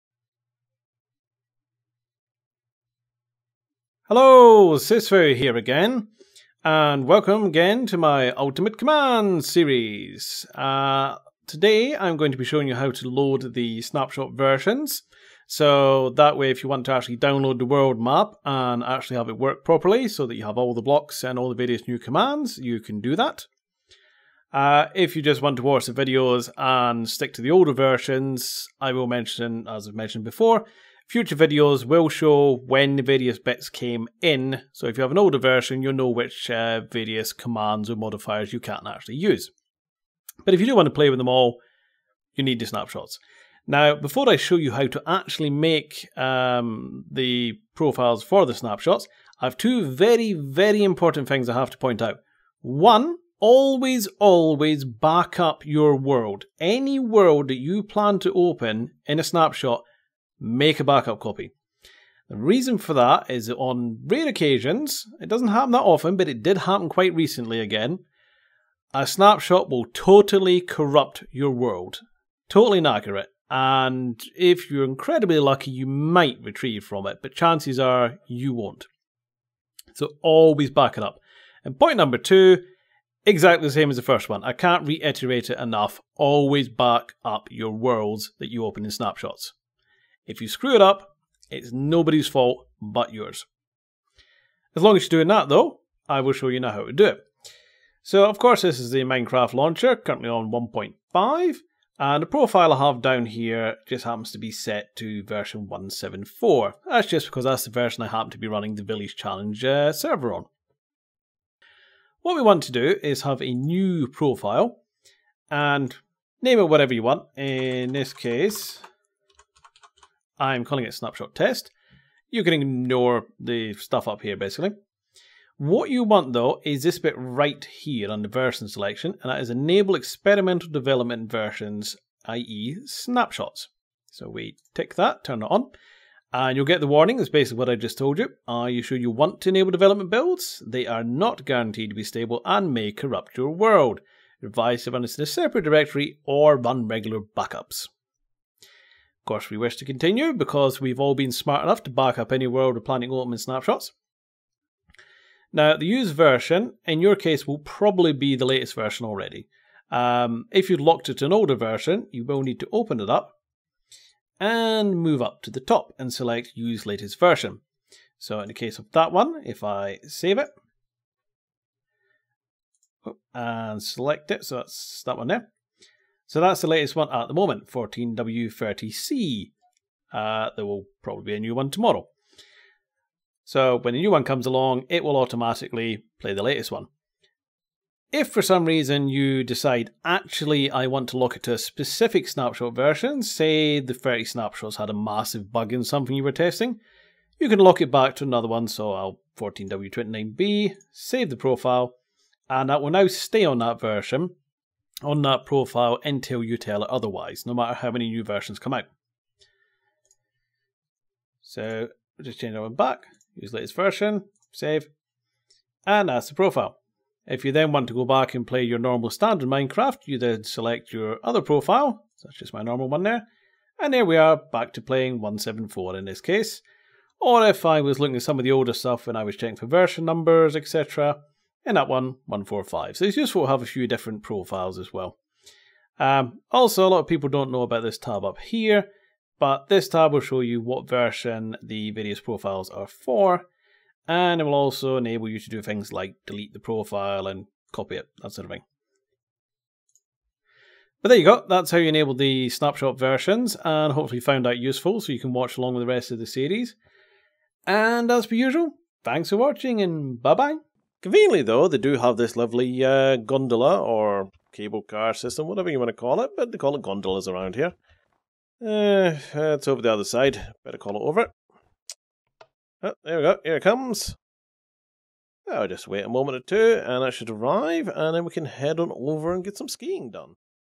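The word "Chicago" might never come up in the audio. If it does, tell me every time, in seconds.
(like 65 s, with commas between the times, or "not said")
not said.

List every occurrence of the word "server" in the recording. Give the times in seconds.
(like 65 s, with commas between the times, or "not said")
109 s.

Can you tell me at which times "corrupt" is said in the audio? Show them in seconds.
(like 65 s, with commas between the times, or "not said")
70 s, 142 s.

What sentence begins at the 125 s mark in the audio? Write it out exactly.
What you want though is this bit right here on the version selection and that is enable experimental development versions, i.e.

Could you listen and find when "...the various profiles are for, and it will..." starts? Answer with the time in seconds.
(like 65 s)
241 s.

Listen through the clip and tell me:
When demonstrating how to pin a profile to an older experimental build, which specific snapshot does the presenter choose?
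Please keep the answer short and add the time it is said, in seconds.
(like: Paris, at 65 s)
14W29B, at 199 s.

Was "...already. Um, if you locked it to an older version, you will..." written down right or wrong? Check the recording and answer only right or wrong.
right.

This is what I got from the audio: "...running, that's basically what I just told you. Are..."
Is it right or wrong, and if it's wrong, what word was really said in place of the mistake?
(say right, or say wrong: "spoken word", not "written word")
wrong: "warning", not "running".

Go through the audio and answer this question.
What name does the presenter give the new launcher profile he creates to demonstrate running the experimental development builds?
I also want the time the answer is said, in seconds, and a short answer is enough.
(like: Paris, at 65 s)
snapshot test, at 120 s.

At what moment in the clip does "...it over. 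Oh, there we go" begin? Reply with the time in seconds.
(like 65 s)
270 s.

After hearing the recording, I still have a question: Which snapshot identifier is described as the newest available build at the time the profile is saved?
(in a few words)
14W30C.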